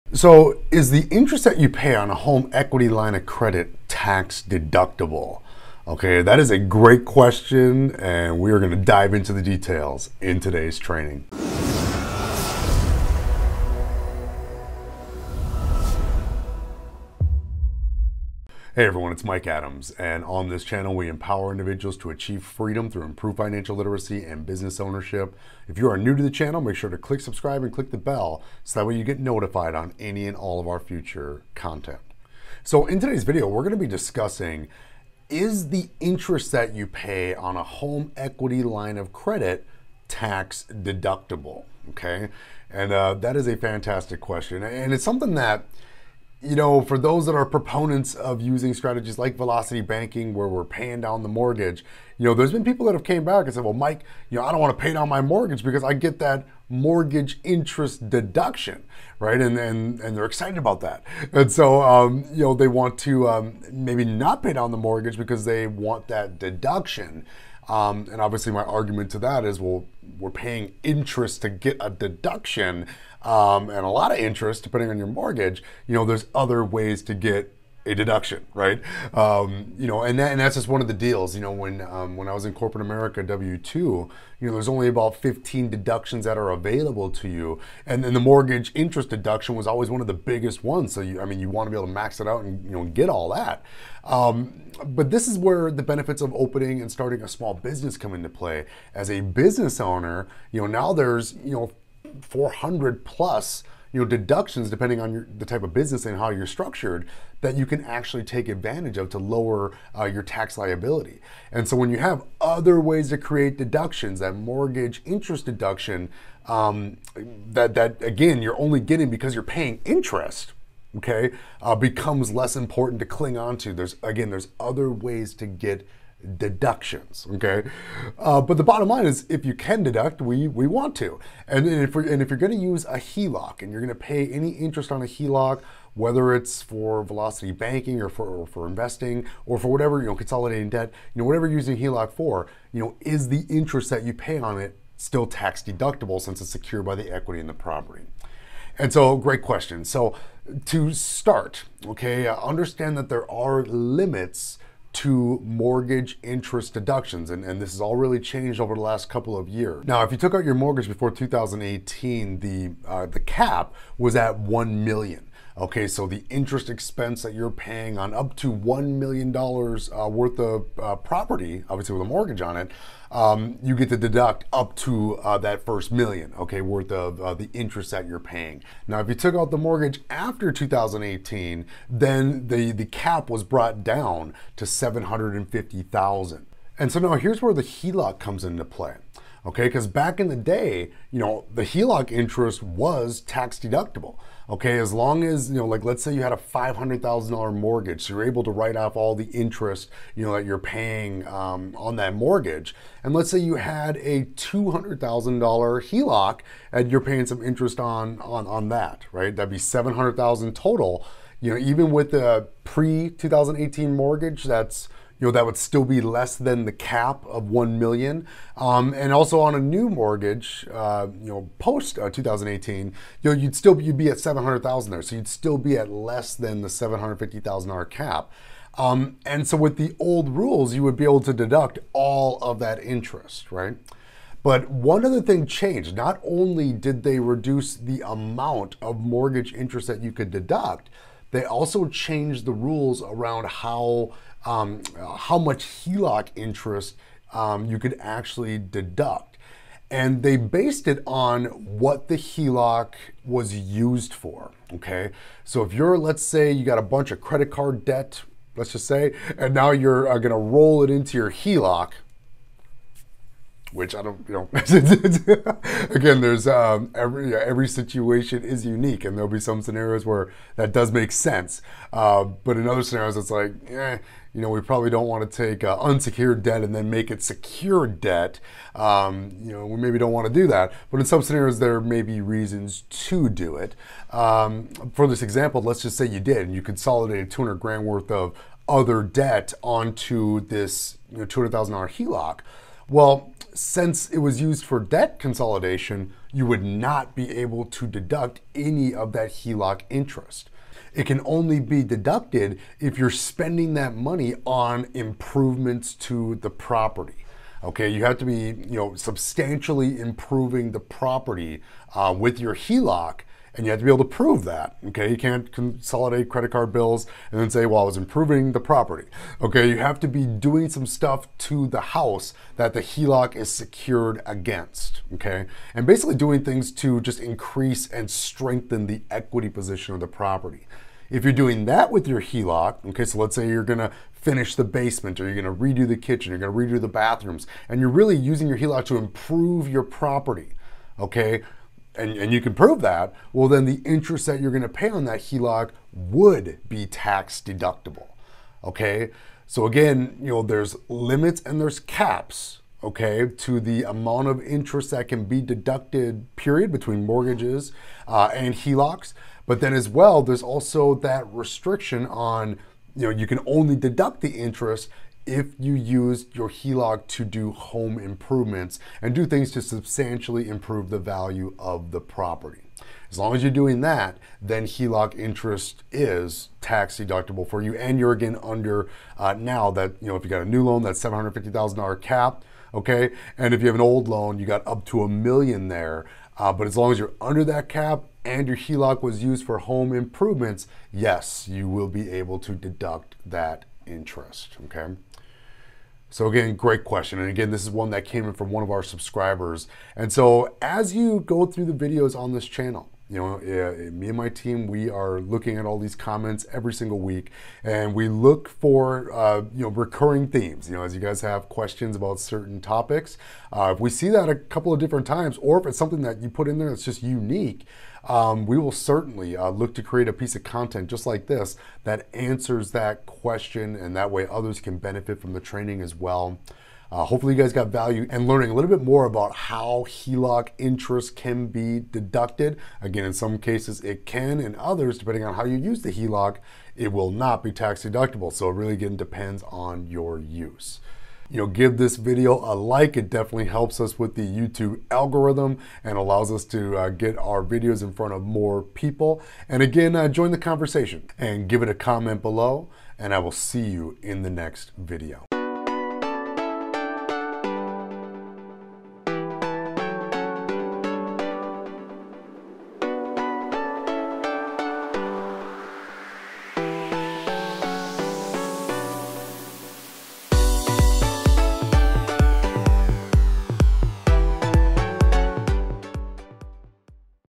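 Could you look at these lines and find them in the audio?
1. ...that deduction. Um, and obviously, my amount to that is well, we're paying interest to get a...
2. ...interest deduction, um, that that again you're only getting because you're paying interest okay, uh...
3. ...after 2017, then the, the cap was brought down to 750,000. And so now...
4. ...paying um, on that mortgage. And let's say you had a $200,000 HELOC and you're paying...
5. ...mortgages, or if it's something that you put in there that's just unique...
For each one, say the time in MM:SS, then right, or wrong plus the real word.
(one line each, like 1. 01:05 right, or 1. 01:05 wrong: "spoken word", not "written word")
1. 01:06 wrong: "argument", not "amount"
2. 01:55 right
3. 03:00 wrong: "2018", not "2017"
4. 03:20 right
5. 06:55 wrong: "times", not "mortgages".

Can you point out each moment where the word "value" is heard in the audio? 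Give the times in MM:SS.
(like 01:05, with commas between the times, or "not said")
06:10, 07:07.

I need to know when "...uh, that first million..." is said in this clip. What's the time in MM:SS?
02:55.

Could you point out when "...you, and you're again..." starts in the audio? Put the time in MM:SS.
06:17.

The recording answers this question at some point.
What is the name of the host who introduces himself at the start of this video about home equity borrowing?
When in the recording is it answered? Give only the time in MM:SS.
00:19.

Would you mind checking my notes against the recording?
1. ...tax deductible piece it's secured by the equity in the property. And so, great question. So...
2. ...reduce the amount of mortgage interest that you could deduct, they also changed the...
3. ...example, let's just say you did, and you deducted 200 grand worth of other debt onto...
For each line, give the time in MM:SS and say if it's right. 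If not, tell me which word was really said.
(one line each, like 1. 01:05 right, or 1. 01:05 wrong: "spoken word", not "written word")
1. 02:25 wrong: "since", not "piece"
2. 03:57 right
3. 04:45 wrong: "consolidated", not "deducted".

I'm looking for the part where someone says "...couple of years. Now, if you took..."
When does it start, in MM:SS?
02:39.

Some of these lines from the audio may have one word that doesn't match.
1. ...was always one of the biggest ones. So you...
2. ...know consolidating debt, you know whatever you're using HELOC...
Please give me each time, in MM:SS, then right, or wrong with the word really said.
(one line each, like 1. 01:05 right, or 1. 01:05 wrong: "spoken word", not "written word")
1. 01:29 right
2. 02:20 right.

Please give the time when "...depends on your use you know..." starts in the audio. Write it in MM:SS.
07:18.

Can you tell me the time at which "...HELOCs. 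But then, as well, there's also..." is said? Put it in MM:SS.
05:58.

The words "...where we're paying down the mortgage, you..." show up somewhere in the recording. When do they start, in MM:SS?
00:50.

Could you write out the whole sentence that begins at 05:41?
and, and you can prove that, well, then the interest that you're going to pay on that HELOC would be tax deductible.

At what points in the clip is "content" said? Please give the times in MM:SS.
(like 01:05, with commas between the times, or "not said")
00:31, 07:00.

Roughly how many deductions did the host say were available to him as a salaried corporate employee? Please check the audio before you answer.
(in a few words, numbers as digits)
15.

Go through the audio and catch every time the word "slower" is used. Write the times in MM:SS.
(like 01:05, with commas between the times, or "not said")
not said.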